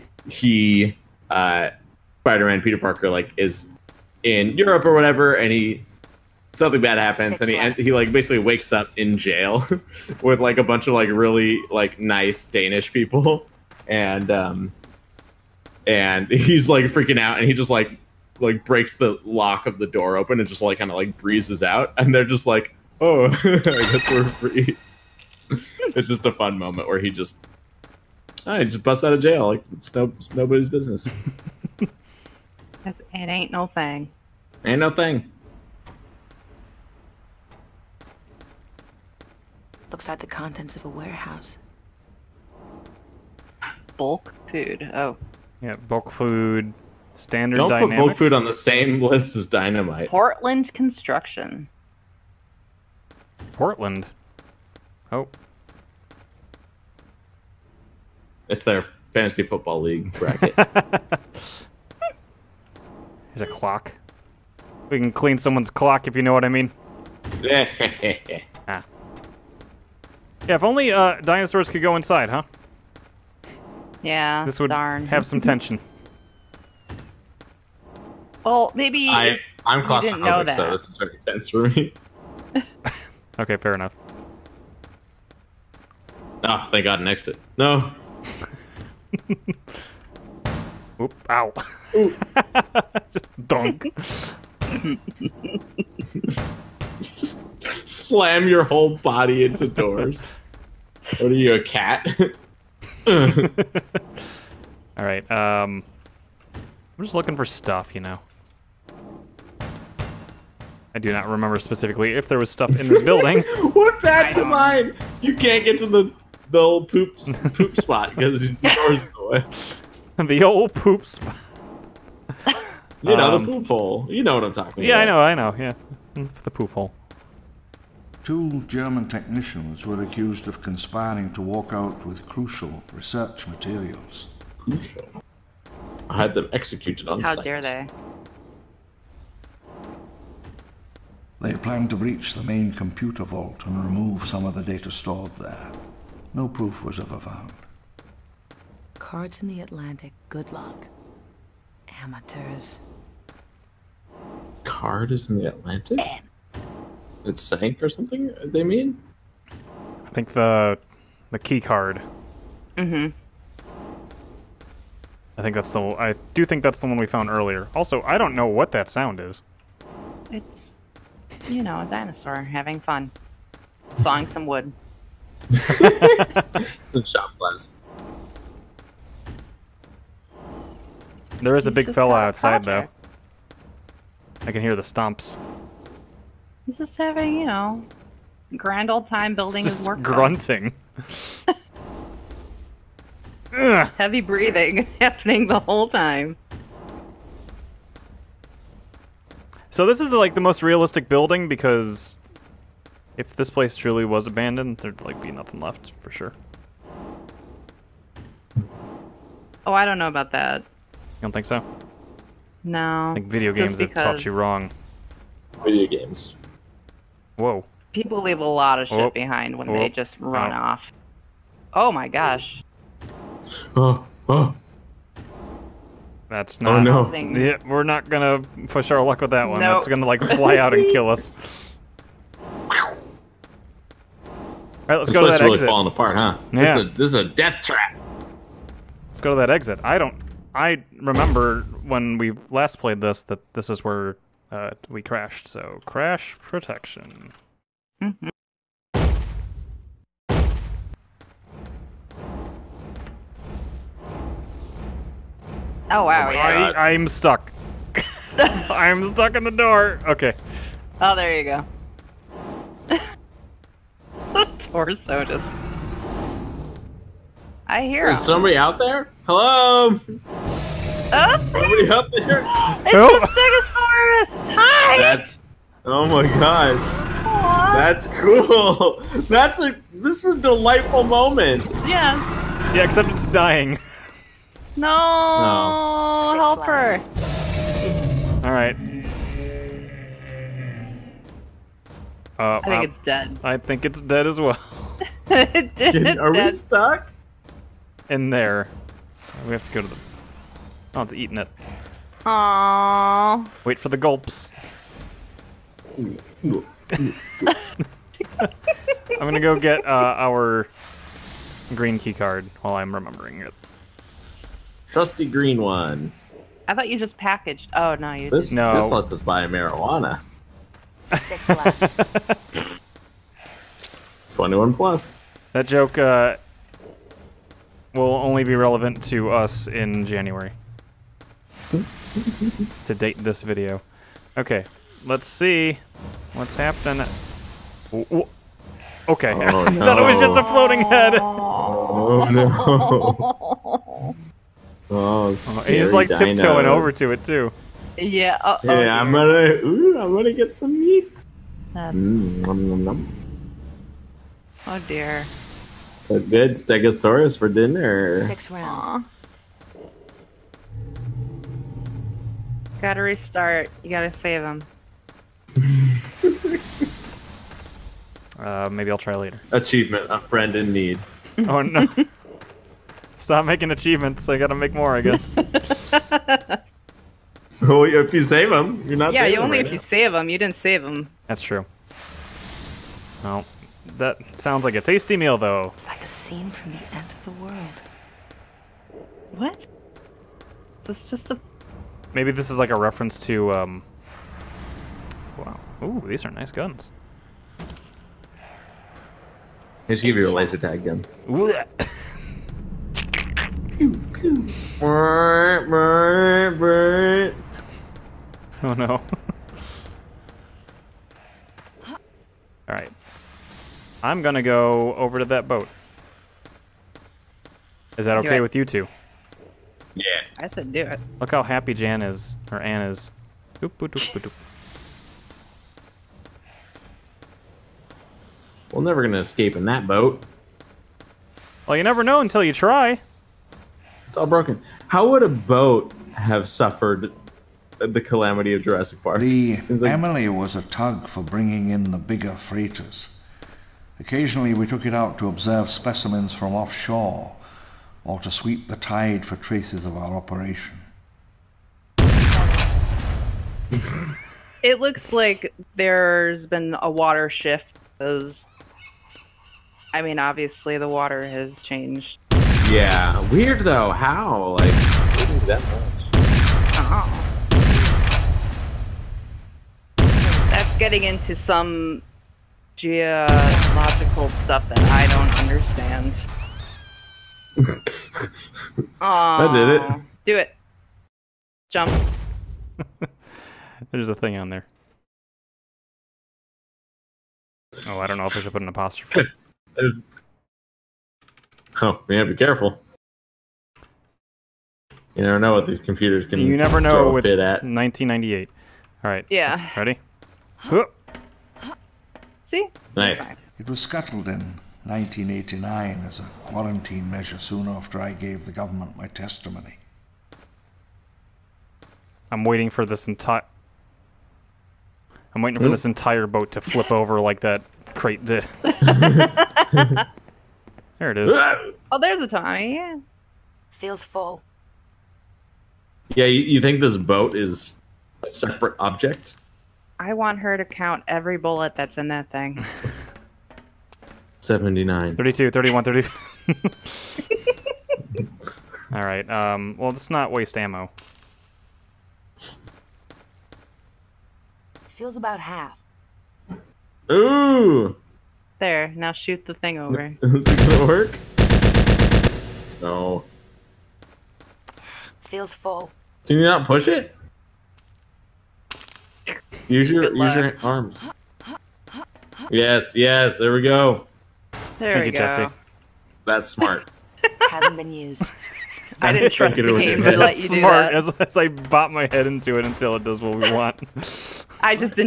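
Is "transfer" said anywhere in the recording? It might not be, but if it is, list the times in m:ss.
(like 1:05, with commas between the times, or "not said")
not said.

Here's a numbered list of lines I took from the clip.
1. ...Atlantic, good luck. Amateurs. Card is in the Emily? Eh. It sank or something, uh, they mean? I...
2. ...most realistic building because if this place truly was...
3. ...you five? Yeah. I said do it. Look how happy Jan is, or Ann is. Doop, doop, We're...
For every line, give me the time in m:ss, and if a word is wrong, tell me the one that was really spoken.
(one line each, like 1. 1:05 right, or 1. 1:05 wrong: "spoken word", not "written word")
1. 2:29 wrong: "Atlantic", not "Emily"
2. 3:20 right
3. 6:58 wrong: "two", not "five".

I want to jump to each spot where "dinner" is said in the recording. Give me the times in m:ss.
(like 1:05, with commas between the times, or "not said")
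5:57.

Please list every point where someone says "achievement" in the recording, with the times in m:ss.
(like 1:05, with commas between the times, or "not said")
6:09, 6:13.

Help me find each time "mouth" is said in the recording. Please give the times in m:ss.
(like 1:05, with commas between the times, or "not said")
not said.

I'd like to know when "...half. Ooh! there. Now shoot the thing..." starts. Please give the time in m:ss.
9:05.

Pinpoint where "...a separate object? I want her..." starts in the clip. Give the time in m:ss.
8:48.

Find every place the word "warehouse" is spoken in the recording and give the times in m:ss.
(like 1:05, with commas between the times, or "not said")
0:40.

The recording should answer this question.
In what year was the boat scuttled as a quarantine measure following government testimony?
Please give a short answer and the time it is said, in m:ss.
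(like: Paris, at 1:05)
1989, at 8:24.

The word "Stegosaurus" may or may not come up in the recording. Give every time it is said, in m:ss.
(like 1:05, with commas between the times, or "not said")
4:33, 5:56.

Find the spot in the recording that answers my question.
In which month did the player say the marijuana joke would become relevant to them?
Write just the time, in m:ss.
5:30.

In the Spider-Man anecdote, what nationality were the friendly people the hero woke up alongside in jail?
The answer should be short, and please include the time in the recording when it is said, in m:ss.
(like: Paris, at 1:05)
Danish, at 0:12.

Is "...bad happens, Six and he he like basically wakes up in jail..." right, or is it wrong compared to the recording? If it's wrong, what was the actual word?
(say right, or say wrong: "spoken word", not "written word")
right.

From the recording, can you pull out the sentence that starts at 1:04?
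We can clean someone's clock if you know what I mean.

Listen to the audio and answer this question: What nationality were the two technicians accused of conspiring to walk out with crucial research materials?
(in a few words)
German.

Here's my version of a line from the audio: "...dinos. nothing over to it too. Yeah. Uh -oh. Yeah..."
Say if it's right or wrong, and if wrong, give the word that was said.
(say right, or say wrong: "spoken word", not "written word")
wrong: "tiptoeing", not "nothing".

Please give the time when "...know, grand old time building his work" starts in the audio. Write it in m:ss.
3:07.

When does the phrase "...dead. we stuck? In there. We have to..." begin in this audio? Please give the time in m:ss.
4:56.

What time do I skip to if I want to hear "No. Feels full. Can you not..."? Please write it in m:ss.
9:12.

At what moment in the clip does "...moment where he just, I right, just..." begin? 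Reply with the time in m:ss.
0:26.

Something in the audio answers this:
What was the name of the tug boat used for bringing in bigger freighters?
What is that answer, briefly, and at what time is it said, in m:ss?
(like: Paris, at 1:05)
Emily, at 7:19.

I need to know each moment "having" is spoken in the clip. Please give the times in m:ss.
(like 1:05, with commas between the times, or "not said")
2:52, 3:06.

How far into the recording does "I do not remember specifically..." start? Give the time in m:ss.
1:50.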